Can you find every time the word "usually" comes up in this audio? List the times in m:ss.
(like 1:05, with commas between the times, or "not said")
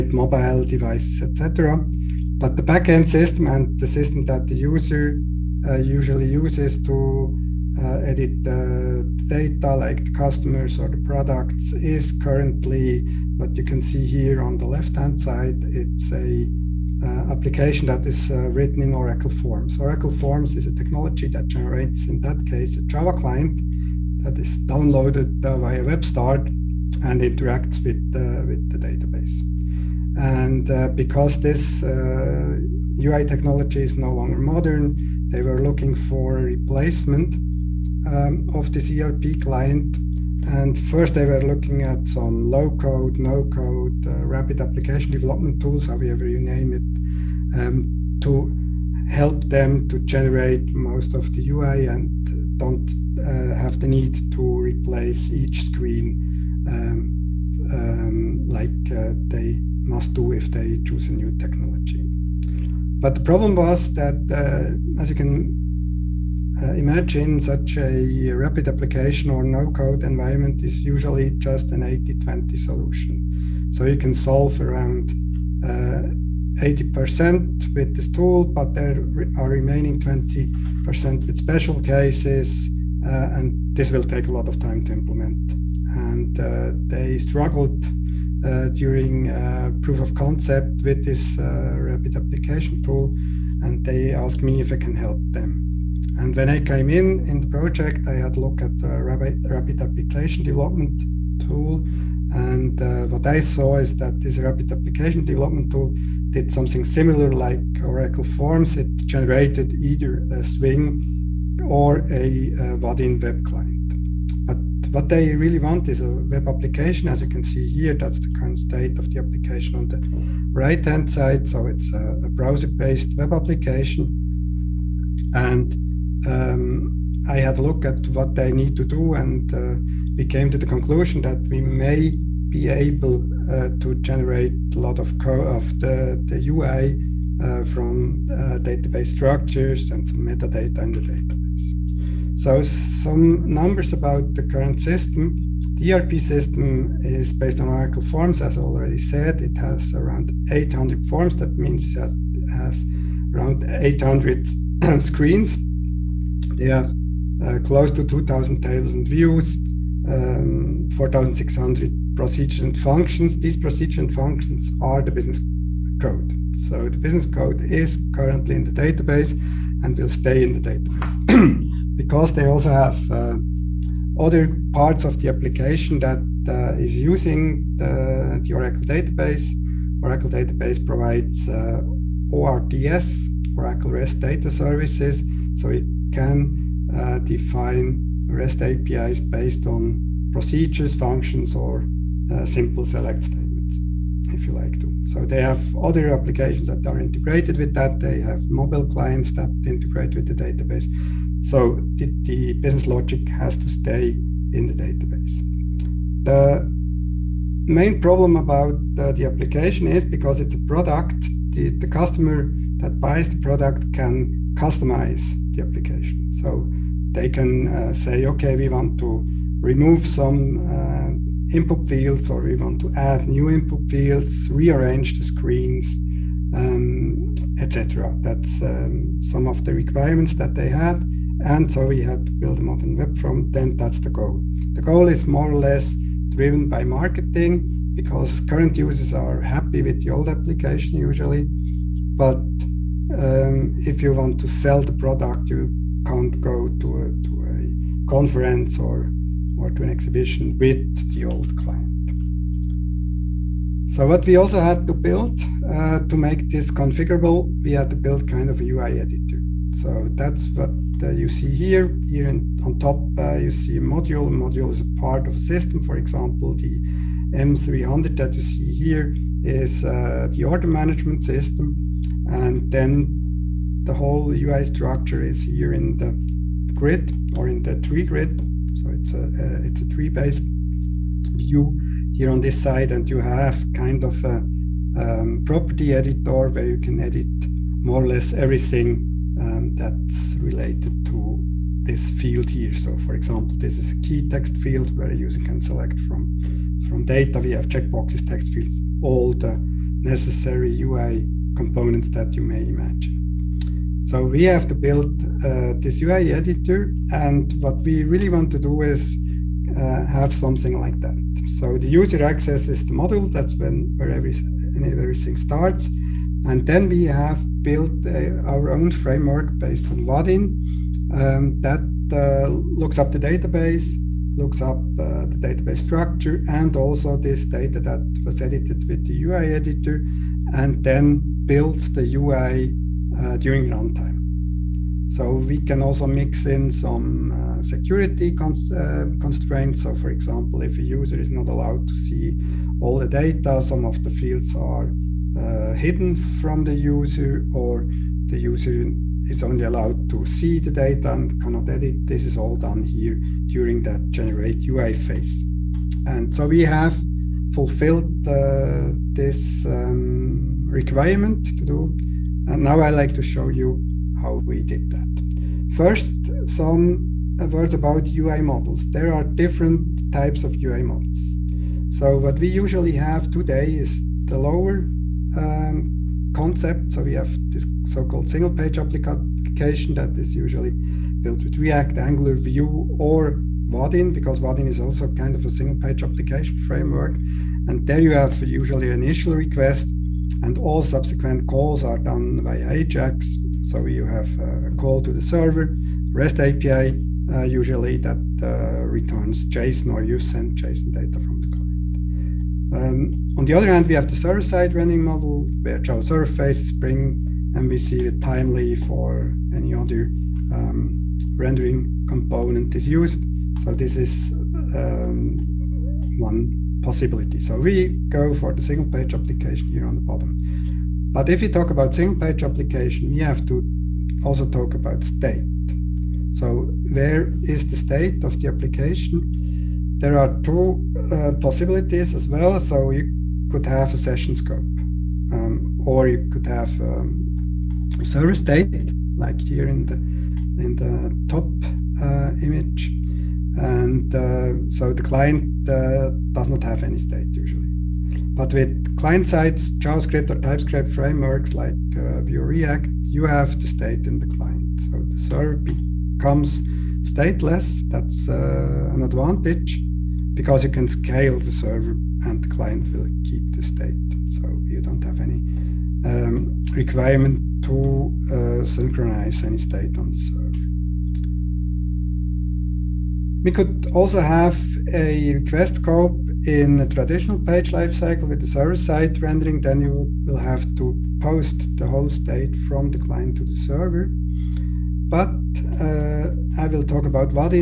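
0:05, 1:10, 4:00, 6:12, 6:20, 6:28, 6:37, 7:27.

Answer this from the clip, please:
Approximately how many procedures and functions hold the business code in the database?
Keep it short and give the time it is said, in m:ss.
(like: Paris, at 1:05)
4,600, at 2:40.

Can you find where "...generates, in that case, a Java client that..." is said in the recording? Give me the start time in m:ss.
0:21.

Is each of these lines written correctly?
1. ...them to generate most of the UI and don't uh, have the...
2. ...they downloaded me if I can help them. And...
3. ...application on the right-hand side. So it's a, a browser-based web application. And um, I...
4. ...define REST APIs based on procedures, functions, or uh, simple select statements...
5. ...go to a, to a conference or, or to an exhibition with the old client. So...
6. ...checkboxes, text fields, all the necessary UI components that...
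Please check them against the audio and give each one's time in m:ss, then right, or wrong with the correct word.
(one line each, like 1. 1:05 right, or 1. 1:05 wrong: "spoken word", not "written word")
1. 0:49 right
2. 1:33 wrong: "asked", not "downloaded"
3. 1:59 right
4. 3:07 right
5. 4:06 right
6. 4:57 right.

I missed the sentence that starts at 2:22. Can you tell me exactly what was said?
So some numbers about the current system.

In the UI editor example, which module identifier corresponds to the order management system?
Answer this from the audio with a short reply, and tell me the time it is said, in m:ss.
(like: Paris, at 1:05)
M300, at 4:27.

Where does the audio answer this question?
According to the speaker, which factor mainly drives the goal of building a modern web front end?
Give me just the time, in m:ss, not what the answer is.
3:56.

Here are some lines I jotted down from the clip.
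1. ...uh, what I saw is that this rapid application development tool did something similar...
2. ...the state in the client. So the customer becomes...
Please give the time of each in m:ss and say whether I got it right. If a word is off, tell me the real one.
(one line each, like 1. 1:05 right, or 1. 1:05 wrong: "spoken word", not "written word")
1. 1:42 right
2. 7:33 wrong: "server", not "customer".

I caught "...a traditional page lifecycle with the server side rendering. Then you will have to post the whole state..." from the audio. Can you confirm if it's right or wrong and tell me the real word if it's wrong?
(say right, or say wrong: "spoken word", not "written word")
right.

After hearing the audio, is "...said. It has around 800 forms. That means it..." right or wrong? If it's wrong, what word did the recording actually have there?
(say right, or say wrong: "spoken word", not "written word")
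right.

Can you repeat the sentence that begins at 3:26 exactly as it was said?
The main problem about the application is because it's a product, the, the customer that buys the product can customize the application.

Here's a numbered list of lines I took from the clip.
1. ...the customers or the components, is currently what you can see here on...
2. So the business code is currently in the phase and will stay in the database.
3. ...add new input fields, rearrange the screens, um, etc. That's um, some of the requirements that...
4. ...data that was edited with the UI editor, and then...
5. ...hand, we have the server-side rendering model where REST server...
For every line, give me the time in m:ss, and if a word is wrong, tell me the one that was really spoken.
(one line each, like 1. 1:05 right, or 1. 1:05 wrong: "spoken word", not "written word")
1. 0:10 wrong: "products", not "components"
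2. 2:46 wrong: "database", not "phase"
3. 3:42 right
4. 5:27 right
5. 6:43 wrong: "Java", not "REST".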